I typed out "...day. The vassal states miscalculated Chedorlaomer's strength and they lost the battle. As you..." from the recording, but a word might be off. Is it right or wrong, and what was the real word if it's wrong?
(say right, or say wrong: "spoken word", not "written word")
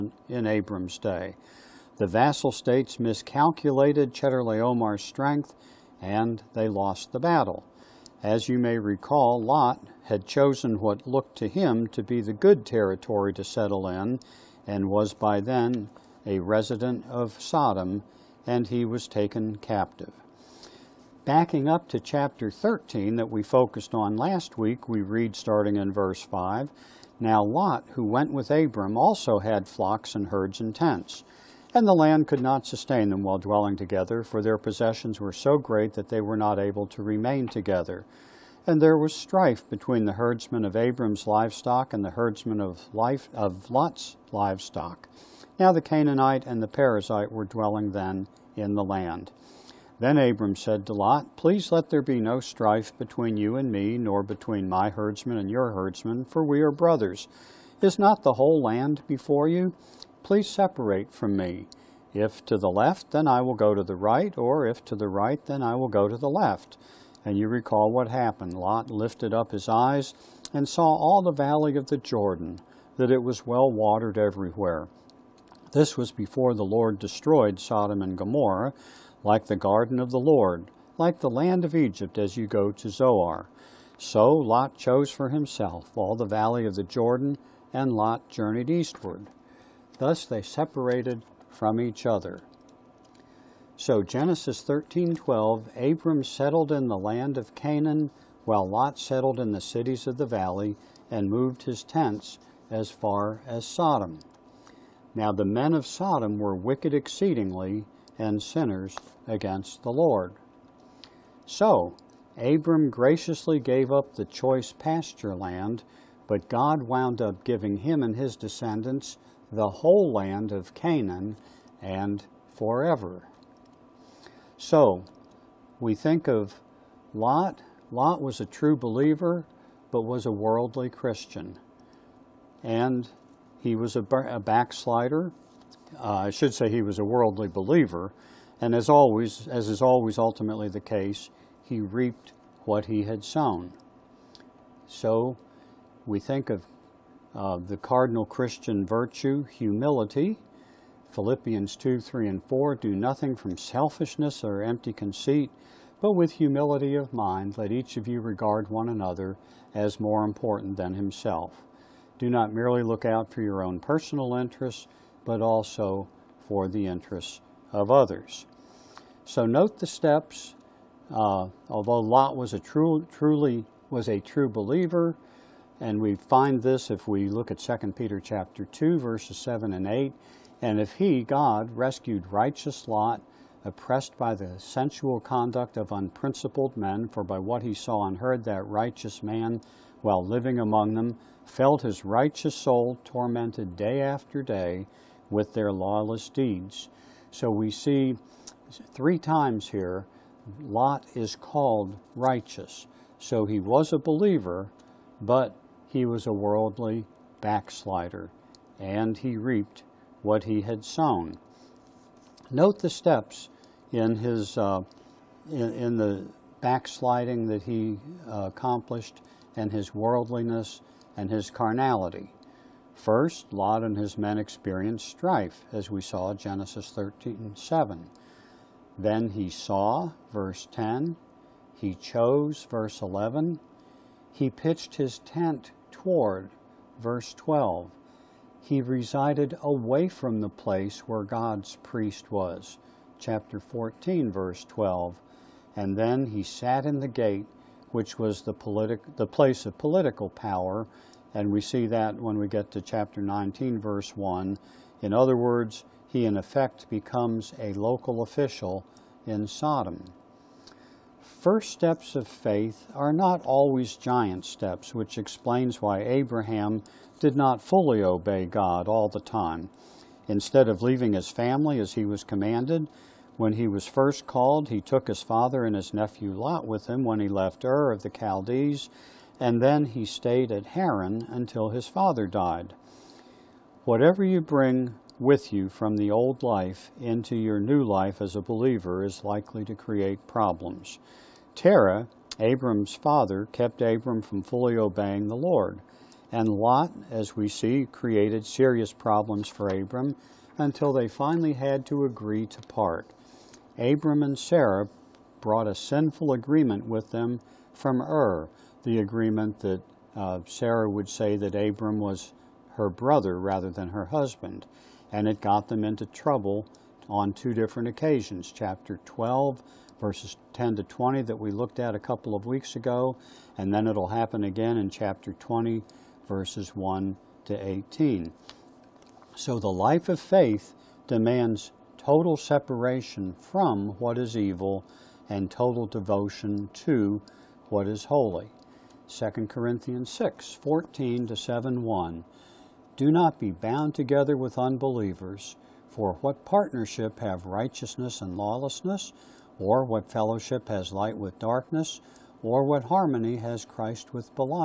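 right.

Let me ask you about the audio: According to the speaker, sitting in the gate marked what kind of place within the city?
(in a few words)
political power.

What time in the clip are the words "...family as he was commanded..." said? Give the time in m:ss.
4:31.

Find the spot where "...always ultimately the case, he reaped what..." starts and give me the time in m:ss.
2:19.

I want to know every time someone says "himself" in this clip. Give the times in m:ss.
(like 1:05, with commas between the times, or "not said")
1:25, 2:40.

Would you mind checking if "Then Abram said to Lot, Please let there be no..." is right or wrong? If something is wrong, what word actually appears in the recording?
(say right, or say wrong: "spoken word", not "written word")
right.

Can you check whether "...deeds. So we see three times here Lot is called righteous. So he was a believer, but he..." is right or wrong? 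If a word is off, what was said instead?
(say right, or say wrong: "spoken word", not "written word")
right.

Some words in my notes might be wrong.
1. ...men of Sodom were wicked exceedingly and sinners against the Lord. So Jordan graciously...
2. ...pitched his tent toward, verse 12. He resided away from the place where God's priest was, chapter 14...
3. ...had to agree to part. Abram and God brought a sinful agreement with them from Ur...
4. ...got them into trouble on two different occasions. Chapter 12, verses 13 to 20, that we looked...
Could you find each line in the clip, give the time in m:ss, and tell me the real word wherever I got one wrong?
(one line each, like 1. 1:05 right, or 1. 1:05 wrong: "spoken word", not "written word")
1. 1:45 wrong: "Abram", not "Jordan"
2. 3:54 right
3. 5:01 wrong: "Sarah", not "God"
4. 5:15 wrong: "10", not "13".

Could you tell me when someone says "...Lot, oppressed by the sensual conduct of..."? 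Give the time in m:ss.
3:02.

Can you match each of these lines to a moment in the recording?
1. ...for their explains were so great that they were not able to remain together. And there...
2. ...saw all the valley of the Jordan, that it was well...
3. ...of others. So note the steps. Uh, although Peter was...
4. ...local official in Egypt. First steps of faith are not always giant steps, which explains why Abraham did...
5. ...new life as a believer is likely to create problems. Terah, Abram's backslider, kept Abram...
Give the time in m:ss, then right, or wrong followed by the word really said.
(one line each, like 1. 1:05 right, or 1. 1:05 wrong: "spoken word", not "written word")
1. 0:34 wrong: "possessions", not "explains"
2. 1:10 right
3. 2:47 wrong: "Lot", not "Peter"
4. 4:17 wrong: "Sodom", not "Egypt"
5. 4:47 wrong: "father", not "backslider".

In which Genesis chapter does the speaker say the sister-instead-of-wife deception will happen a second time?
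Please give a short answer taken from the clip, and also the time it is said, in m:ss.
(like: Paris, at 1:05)
Chapter 20, at 5:24.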